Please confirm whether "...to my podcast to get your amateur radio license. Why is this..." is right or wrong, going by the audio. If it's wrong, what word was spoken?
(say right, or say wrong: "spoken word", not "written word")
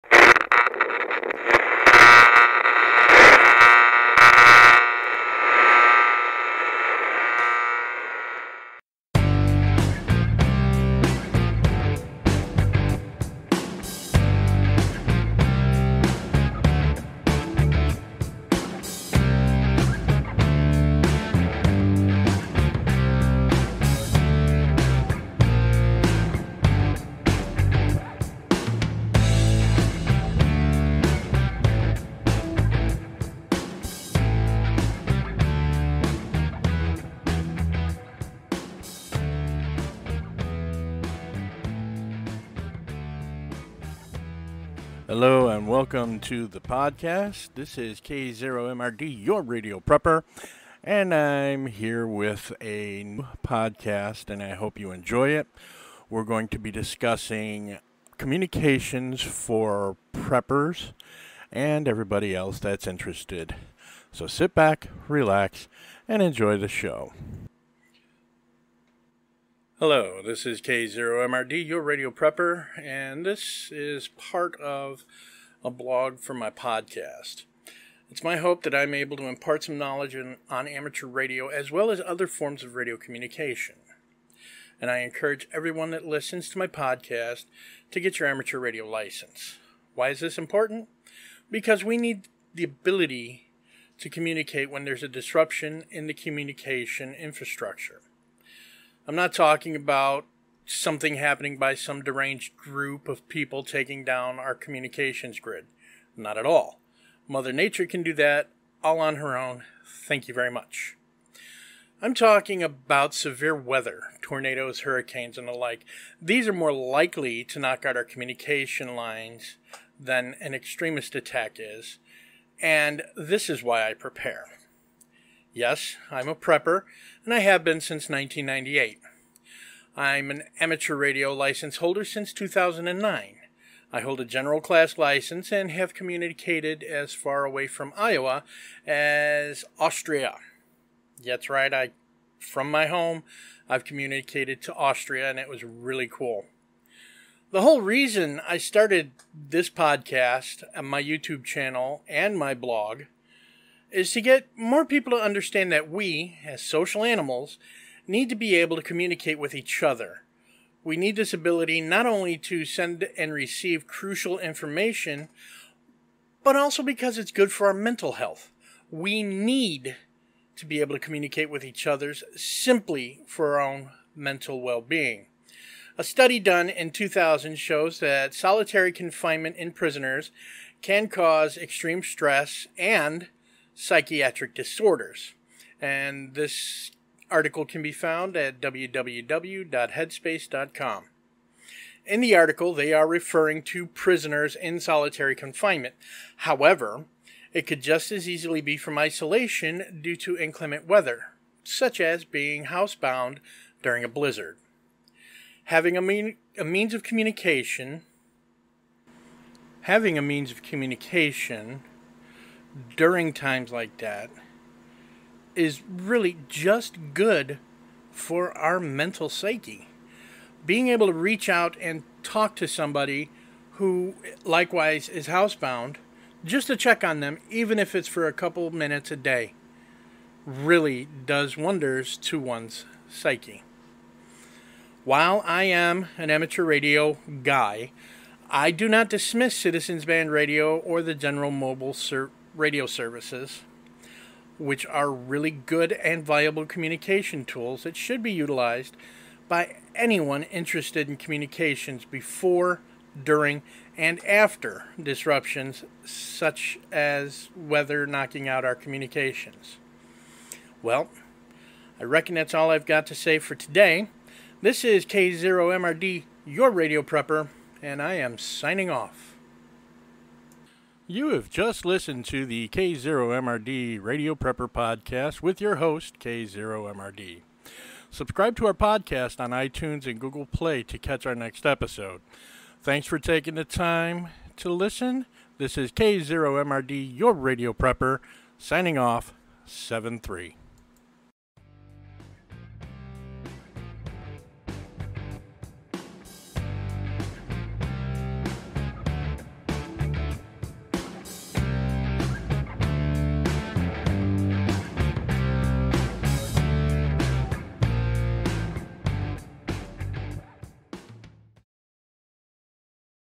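right.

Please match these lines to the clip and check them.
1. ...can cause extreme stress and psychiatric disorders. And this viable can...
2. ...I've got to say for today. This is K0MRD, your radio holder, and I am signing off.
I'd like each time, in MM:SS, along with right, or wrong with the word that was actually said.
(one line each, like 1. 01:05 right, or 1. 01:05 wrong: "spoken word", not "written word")
1. 03:00 wrong: "article", not "viable"
2. 04:22 wrong: "prepper", not "holder".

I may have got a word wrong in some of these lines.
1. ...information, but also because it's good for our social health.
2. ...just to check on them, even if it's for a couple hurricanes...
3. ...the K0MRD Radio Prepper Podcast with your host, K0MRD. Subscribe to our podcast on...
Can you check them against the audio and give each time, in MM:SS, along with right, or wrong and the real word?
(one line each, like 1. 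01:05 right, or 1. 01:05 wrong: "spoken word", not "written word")
1. 02:44 wrong: "mental", not "social"
2. 03:46 wrong: "minutes", not "hurricanes"
3. 04:32 right.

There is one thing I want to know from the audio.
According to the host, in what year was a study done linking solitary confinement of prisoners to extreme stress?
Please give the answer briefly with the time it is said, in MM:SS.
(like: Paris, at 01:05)
2000, at 02:56.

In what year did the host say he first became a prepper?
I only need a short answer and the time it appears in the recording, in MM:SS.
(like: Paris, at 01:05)
1998, at 02:08.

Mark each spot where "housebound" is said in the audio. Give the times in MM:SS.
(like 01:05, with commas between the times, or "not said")
03:22, 03:45.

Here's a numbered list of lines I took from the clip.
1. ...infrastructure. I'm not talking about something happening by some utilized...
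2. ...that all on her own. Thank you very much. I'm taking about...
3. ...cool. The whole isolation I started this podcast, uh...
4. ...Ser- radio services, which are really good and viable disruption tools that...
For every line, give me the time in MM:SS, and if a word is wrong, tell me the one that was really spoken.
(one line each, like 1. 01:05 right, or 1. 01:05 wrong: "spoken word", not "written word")
1. 01:37 wrong: "deranged", not "utilized"
2. 01:48 wrong: "talking", not "taking"
3. 02:26 wrong: "reason", not "isolation"
4. 04:01 wrong: "communication", not "disruption".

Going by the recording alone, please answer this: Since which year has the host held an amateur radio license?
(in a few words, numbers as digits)
2009.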